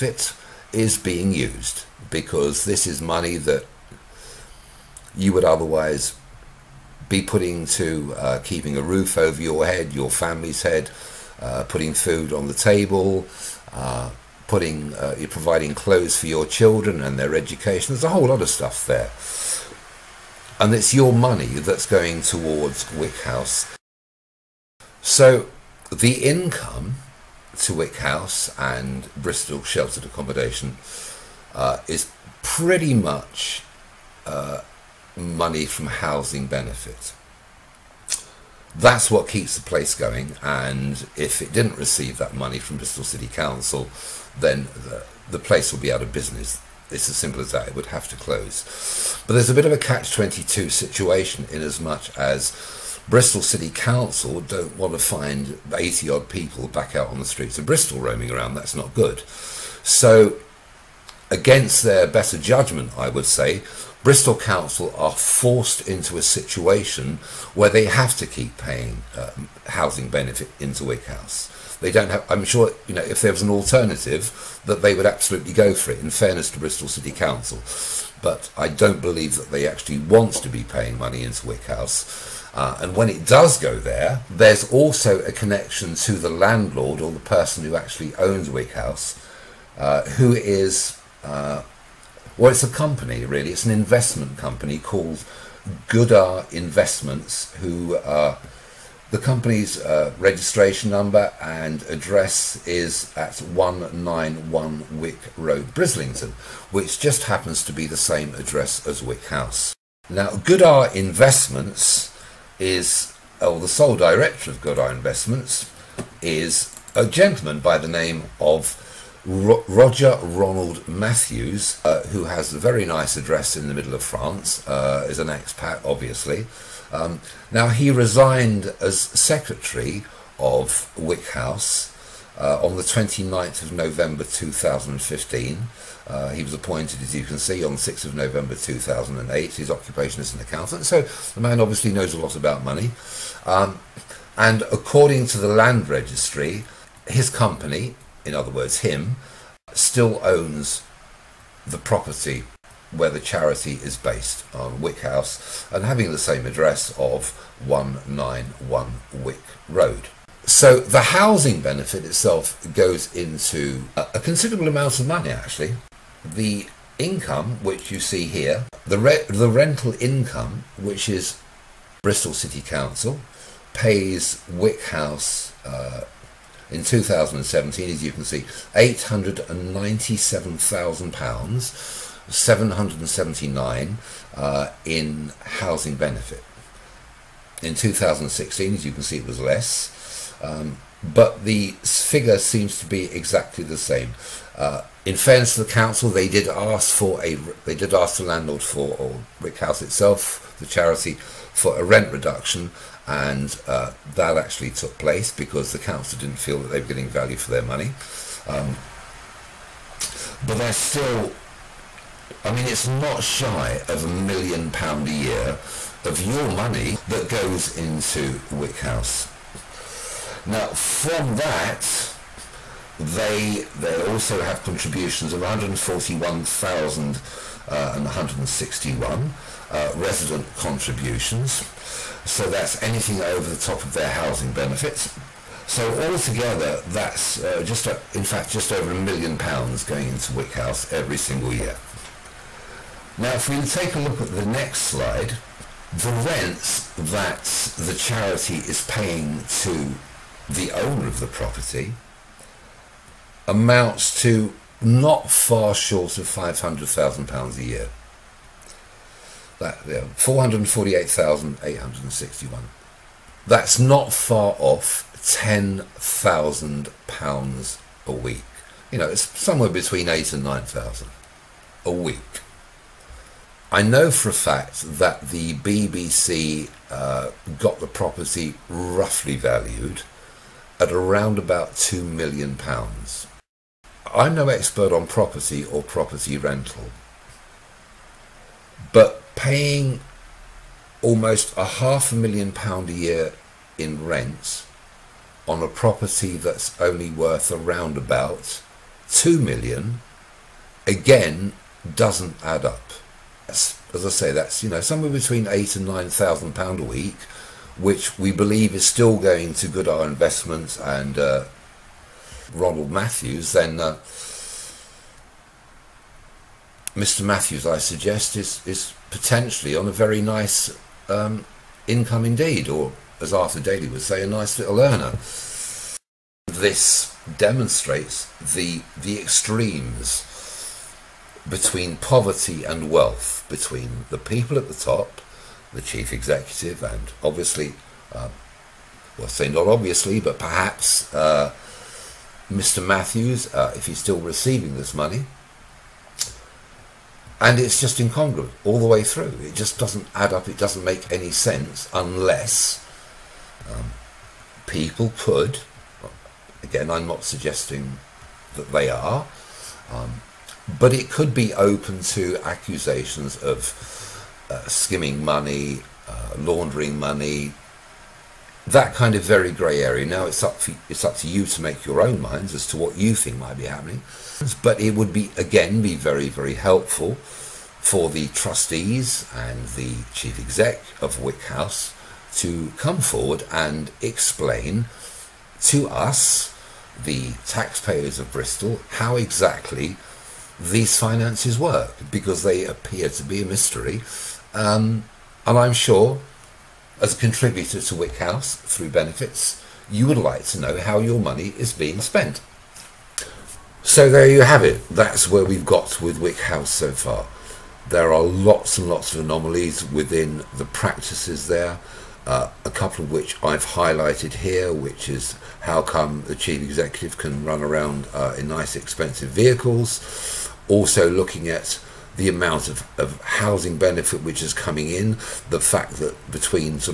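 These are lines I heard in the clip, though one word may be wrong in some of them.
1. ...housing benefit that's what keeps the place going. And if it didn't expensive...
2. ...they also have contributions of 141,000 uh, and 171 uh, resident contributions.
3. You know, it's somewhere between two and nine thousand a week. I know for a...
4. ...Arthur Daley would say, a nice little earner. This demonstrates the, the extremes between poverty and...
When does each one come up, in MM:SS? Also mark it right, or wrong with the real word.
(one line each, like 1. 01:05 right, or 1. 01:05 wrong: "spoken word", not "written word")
1. 00:35 wrong: "receive", not "expensive"
2. 03:43 wrong: "161", not "171"
3. 04:28 wrong: "eight", not "two"
4. 05:23 right.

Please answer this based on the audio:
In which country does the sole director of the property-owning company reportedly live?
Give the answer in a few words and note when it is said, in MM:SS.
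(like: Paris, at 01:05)
France, at 02:04.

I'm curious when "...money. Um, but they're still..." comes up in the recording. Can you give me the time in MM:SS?
03:27.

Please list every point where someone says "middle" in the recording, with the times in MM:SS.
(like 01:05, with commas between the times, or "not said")
02:03.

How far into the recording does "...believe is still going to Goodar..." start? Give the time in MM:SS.
05:08.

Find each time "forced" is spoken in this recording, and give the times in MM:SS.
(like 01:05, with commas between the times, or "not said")
01:05.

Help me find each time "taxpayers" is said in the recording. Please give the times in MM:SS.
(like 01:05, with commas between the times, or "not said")
06:27.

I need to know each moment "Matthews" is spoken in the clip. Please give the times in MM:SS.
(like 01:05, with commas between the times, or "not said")
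02:00, 05:12, 05:17, 05:42.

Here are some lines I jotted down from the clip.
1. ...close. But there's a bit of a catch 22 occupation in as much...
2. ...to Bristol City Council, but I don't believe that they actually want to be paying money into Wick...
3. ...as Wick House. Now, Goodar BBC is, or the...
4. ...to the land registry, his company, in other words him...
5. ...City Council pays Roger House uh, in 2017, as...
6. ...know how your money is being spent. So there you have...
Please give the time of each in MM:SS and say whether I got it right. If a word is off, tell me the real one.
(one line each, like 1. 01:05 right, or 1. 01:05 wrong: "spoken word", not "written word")
1. 00:48 wrong: "situation", not "occupation"
2. 01:16 right
3. 01:48 wrong: "Investments", not "BBC"
4. 02:25 right
5. 02:52 wrong: "Wick", not "Roger"
6. 06:40 right.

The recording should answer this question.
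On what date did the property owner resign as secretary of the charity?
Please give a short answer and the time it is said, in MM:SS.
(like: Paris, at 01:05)
29 November 2015, at 02:12.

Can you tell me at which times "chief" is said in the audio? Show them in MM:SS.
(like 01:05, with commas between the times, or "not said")
05:35, 06:20, 06:56.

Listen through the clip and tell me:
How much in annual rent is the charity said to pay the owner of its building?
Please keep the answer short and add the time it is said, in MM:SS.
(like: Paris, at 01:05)
£448,861, at 04:20.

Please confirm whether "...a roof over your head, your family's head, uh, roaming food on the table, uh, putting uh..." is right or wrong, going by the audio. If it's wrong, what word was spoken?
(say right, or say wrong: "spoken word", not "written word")
wrong: "putting", not "roaming".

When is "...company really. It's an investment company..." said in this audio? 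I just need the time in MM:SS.
01:32.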